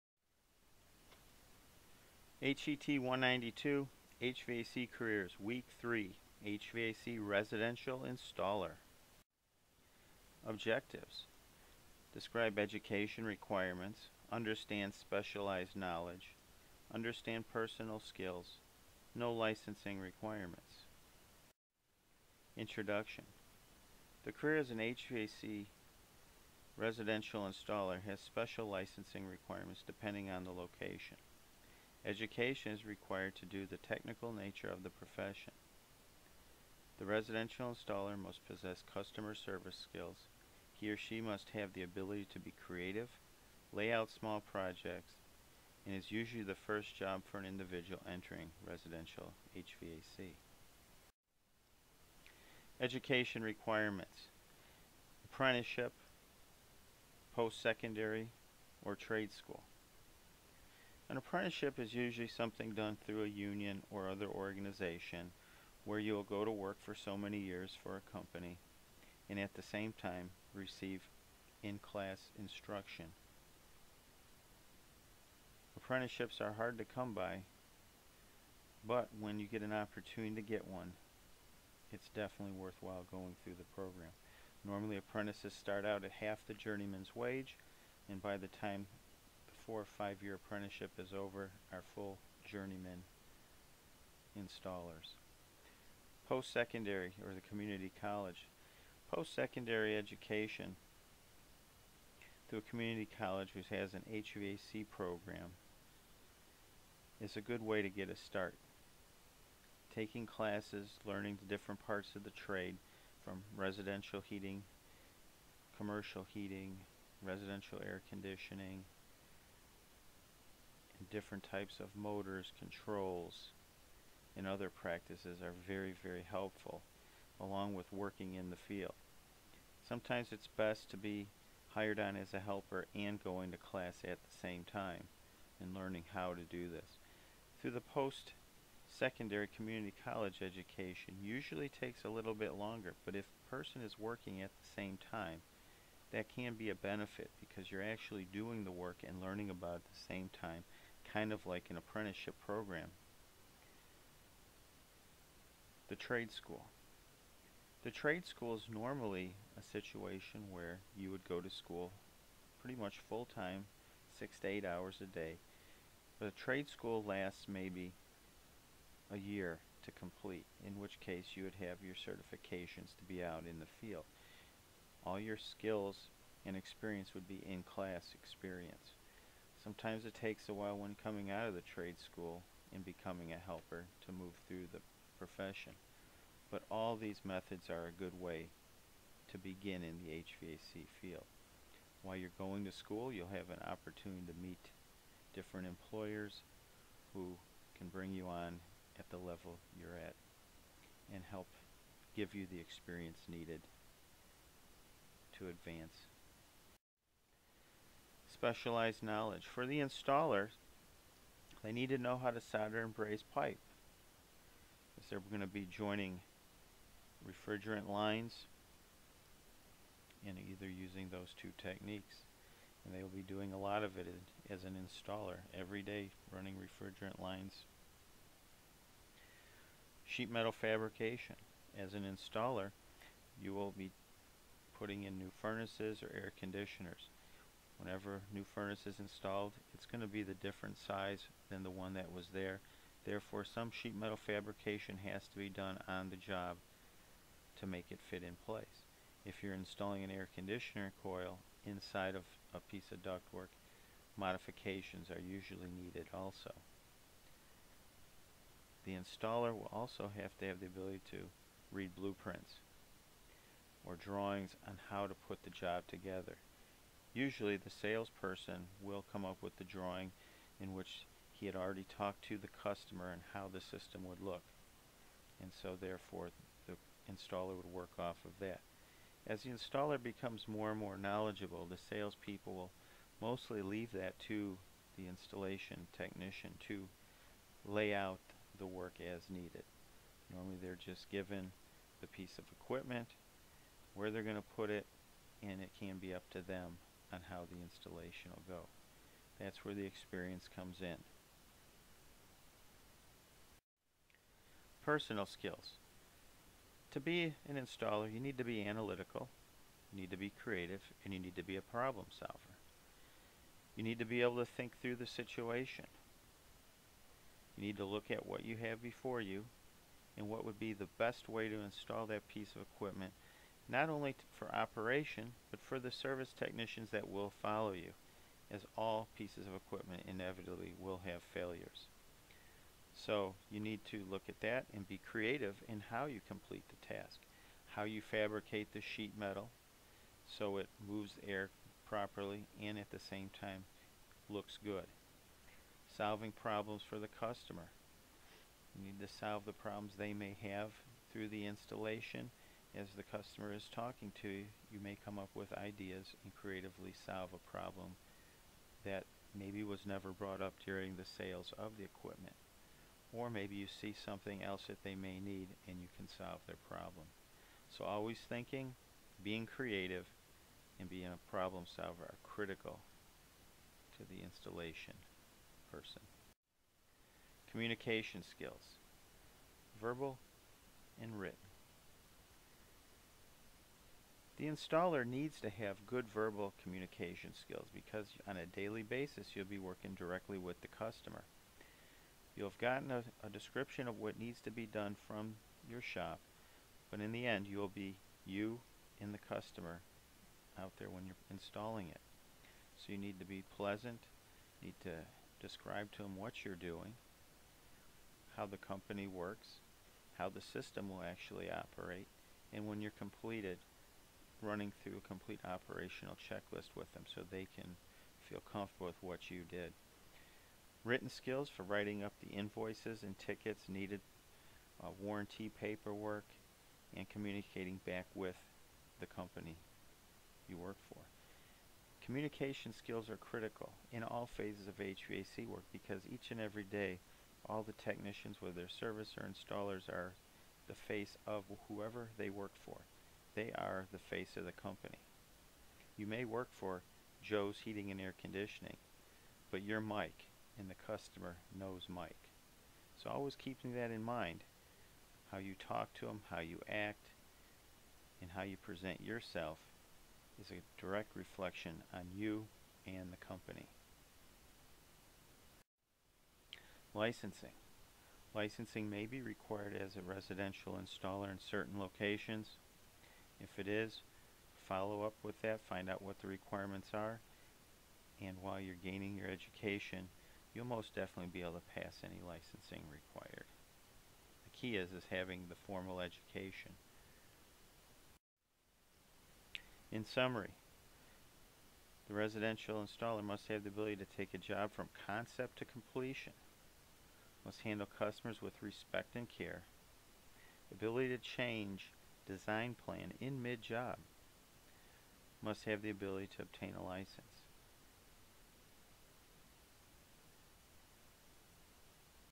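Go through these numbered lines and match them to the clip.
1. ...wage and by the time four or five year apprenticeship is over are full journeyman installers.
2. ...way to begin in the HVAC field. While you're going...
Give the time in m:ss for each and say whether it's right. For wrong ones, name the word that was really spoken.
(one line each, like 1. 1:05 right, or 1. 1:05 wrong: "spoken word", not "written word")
1. 1:27 right
2. 3:08 right.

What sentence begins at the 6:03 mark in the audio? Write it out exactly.
Or maybe you see something else that they may need and you can solve their problem.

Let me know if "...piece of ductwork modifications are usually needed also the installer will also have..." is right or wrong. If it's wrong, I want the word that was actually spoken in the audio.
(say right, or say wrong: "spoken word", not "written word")
right.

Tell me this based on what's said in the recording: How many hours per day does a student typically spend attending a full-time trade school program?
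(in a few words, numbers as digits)
6 to 8.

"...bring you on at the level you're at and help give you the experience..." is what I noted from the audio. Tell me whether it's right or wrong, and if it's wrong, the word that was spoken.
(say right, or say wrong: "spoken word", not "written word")
right.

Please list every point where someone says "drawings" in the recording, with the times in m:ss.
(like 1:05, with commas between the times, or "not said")
4:23, 4:29.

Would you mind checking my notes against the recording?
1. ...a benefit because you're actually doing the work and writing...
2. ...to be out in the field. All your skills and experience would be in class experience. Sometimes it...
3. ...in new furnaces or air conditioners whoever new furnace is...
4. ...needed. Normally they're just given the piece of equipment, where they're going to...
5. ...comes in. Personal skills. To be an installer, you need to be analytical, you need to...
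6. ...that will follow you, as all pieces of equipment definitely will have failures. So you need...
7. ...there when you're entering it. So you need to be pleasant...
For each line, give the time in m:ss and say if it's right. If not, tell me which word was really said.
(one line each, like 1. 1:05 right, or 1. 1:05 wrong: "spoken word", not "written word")
1. 2:26 wrong: "learning", not "writing"
2. 2:52 right
3. 3:55 wrong: "whenever", not "whoever"
4. 4:49 right
5. 5:00 right
6. 5:26 wrong: "inevitably", not "definitely"
7. 6:40 wrong: "installing", not "entering".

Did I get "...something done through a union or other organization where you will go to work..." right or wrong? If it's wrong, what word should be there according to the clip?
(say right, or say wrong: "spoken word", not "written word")
right.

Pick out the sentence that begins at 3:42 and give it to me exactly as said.
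And they will be doing a lot of it as an installer every day, running refrigerant lines.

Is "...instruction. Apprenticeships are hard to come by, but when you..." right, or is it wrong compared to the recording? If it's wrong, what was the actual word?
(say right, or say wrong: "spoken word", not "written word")
right.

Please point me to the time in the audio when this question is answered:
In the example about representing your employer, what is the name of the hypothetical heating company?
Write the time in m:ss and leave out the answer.
7:27.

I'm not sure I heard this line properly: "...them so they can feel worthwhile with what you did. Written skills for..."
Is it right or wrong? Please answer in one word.
wrong.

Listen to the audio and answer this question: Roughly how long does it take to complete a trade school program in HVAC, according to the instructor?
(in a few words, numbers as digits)
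a year.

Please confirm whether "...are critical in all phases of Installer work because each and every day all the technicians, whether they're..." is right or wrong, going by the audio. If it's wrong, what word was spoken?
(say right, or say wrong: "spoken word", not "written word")
wrong: "HVAC", not "Installer".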